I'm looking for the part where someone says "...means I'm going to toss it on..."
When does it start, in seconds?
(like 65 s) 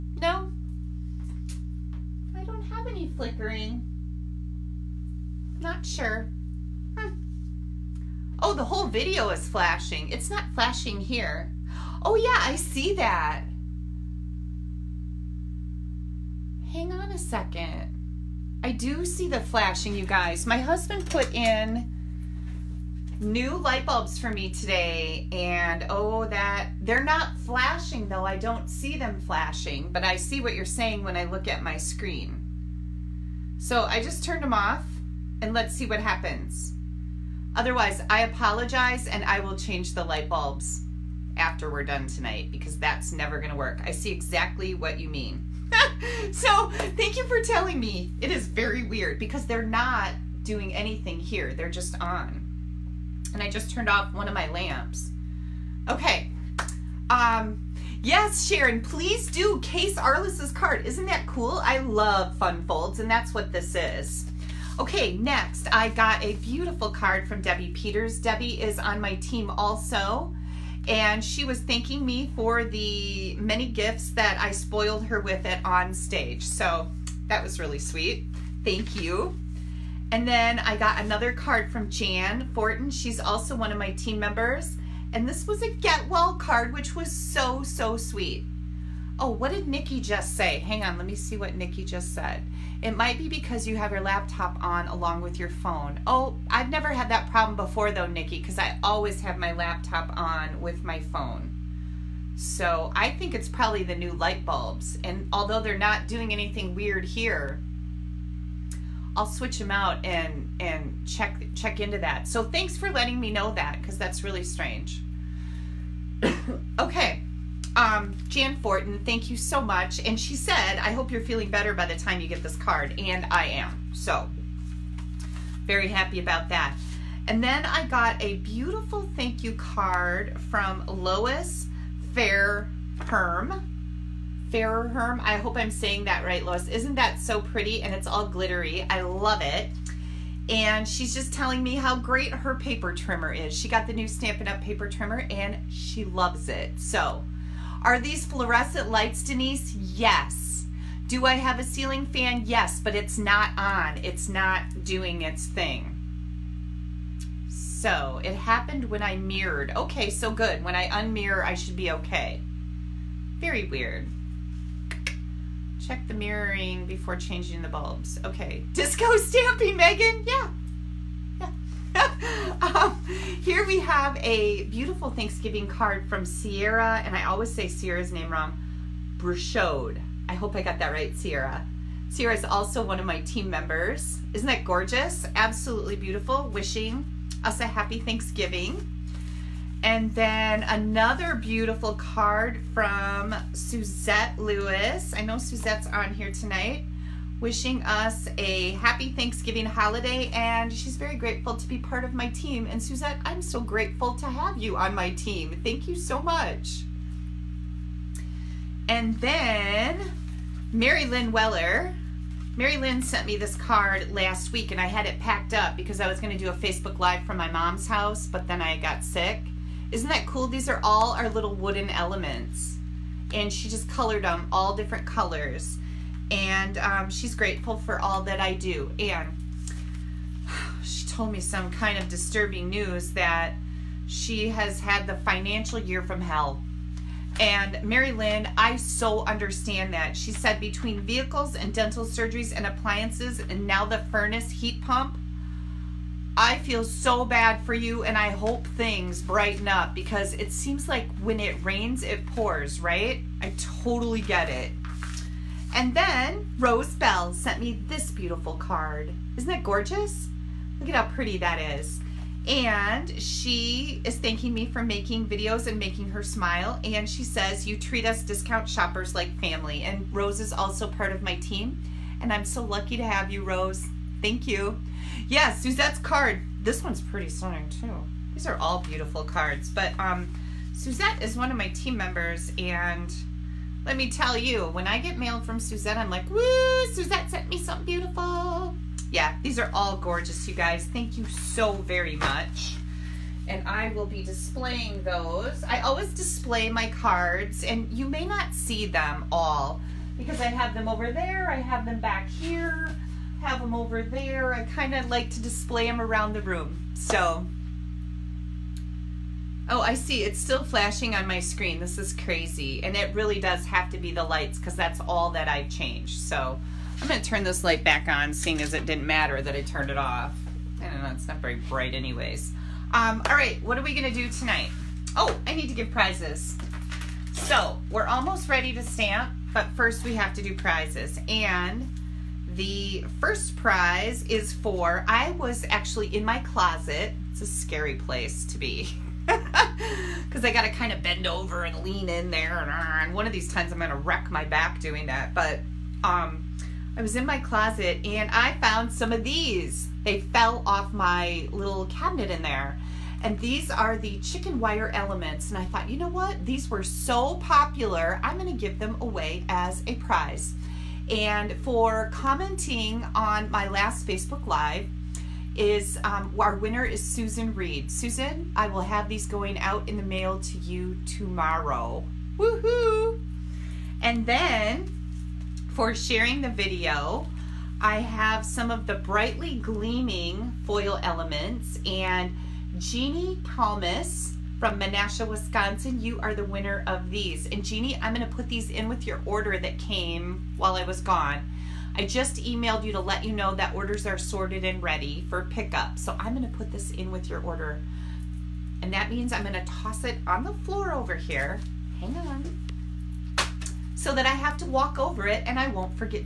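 399 s.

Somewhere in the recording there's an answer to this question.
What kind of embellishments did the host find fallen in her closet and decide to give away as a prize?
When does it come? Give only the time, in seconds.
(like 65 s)
354 s.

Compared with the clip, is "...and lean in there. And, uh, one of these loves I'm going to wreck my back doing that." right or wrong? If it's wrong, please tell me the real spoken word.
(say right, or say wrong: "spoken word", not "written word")
wrong: "times", not "loves".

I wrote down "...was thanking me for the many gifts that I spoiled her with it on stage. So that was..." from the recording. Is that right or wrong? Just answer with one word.
right.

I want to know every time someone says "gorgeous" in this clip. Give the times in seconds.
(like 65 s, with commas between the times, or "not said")
184 s, 259 s, 289 s.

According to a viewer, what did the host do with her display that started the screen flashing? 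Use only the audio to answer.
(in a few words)
Mirrored.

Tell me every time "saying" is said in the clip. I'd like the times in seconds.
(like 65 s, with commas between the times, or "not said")
30 s, 135 s.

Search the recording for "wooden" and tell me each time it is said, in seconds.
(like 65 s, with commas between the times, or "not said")
221 s.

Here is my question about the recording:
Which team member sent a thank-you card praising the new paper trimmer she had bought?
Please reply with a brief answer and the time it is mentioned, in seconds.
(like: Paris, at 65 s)
Lois Fair Herm, at 130 s.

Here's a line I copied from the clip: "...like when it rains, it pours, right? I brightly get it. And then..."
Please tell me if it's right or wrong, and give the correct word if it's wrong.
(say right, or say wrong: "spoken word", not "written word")
wrong: "totally", not "brightly".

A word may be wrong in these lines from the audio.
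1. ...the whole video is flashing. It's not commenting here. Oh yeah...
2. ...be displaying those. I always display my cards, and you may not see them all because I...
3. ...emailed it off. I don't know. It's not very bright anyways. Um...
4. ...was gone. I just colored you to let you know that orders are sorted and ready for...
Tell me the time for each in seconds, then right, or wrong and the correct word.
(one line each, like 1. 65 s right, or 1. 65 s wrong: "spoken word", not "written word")
1. 8 s wrong: "flashing", not "commenting"
2. 294 s right
3. 319 s wrong: "turned", not "emailed"
4. 390 s wrong: "emailed", not "colored".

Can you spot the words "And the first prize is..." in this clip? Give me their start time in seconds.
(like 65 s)
331 s.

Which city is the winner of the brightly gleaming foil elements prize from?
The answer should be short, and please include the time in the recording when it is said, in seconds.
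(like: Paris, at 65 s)
Menasha, Wisconsin, at 384 s.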